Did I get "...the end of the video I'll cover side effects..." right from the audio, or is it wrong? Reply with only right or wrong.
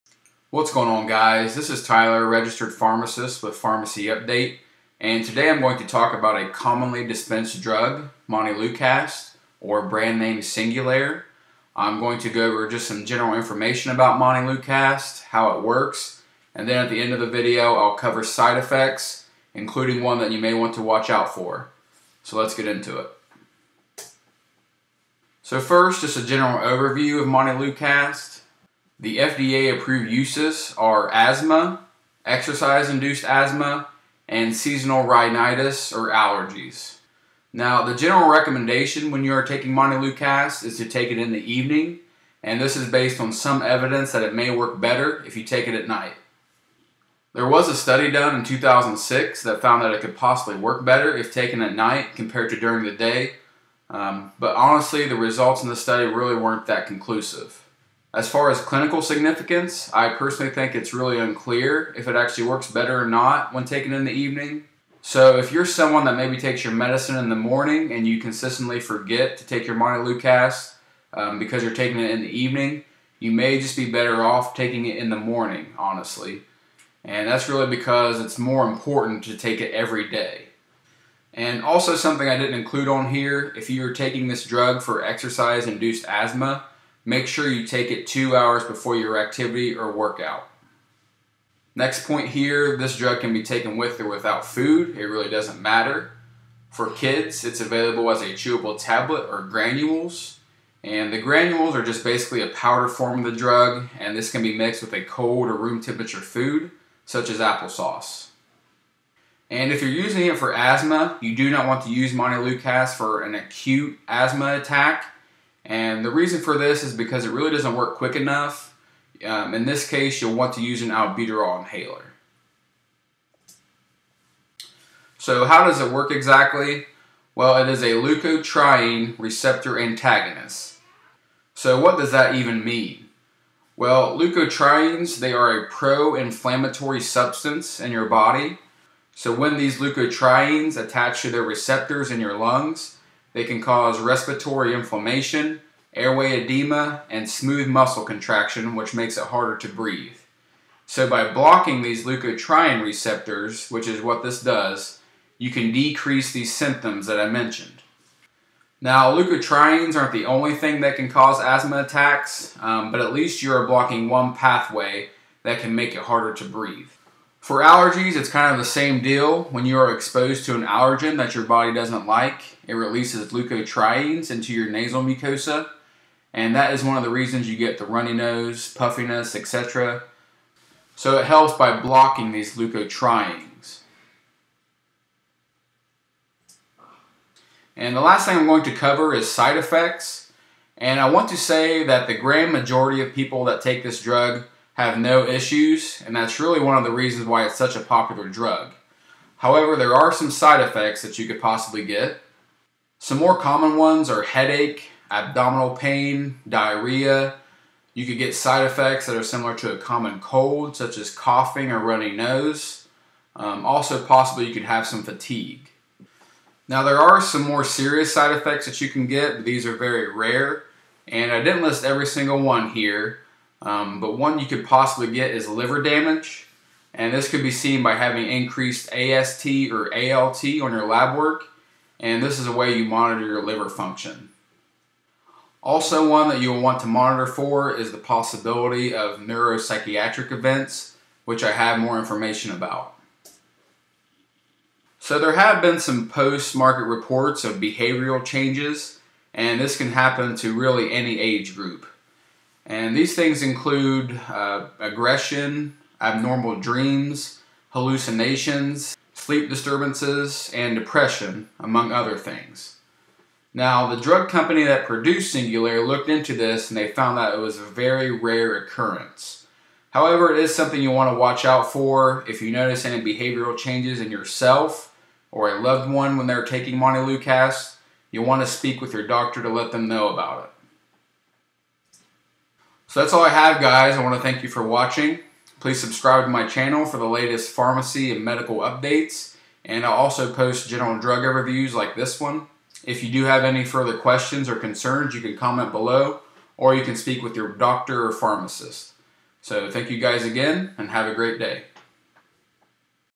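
right.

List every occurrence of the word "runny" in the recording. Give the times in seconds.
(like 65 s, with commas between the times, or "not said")
177 s, 211 s.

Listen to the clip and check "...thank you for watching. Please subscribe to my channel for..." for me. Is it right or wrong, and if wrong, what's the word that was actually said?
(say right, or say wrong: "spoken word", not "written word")
right.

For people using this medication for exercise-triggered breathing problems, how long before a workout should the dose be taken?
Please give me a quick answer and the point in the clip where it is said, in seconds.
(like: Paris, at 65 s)
two hours, at 88 s.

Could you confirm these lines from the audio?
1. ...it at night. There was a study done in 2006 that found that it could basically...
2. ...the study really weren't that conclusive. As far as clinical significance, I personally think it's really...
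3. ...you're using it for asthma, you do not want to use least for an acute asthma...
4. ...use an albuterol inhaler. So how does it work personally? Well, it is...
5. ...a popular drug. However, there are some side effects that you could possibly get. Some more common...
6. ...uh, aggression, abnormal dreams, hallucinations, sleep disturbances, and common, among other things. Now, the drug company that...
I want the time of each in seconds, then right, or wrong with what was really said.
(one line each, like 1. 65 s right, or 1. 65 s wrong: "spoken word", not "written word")
1. 45 s wrong: "possibly", not "basically"
2. 55 s right
3. 109 s wrong: "montelukast", not "least"
4. 120 s wrong: "exactly", not "personally"
5. 197 s right
6. 254 s wrong: "depression", not "common".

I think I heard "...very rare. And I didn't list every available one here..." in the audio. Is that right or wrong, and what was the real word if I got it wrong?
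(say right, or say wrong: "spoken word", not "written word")
wrong: "single", not "available".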